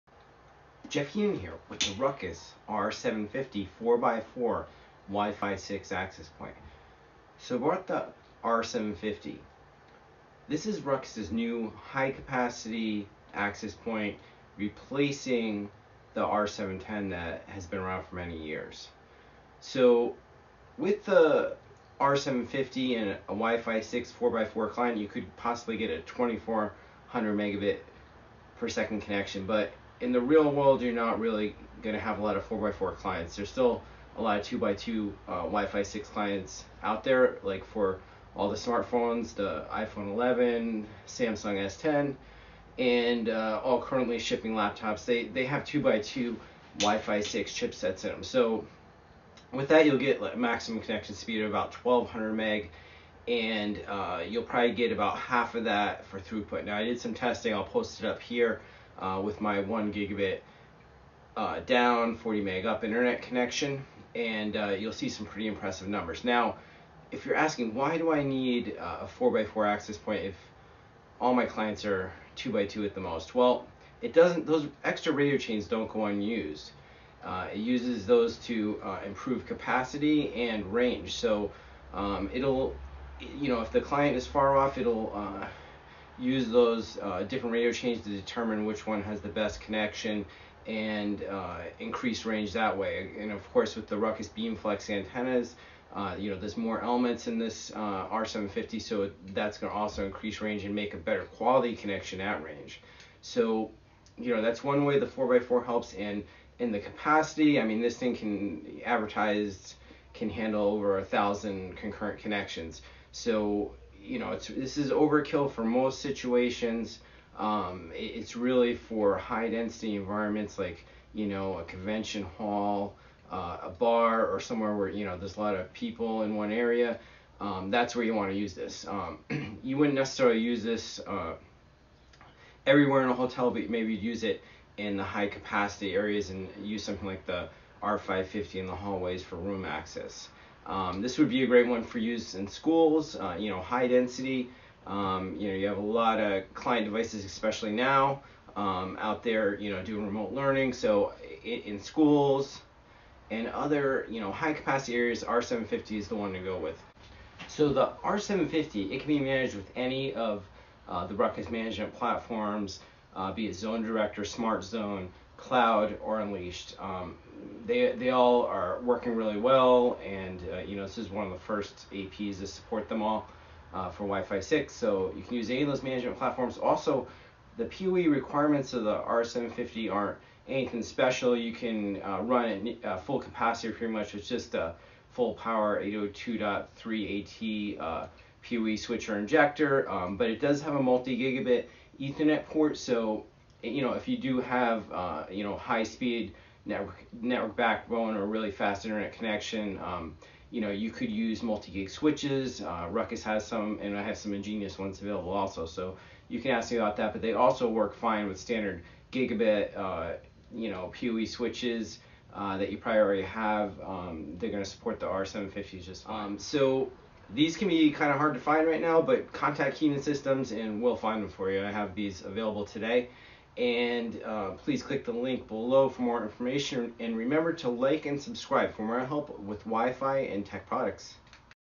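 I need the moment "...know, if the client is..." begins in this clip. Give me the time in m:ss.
1:23.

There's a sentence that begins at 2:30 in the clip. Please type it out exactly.
So in, in schools and other, you know, high capacity areas, R750 is the one to go with.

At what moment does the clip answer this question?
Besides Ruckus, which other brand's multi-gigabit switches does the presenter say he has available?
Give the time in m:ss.
3:24.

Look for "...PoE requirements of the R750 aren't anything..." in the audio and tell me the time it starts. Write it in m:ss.
2:57.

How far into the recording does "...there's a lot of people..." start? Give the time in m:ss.
2:05.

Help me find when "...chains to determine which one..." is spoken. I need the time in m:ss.
1:27.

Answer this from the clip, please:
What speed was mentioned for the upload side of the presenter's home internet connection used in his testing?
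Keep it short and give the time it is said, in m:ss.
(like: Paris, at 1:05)
40 meg, at 1:02.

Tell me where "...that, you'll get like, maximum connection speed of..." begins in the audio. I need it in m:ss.
0:49.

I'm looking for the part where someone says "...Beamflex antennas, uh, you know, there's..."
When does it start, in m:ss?
1:34.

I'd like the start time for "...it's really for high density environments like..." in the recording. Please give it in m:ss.
1:58.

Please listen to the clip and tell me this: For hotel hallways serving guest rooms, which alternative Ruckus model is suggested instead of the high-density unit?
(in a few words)
R550.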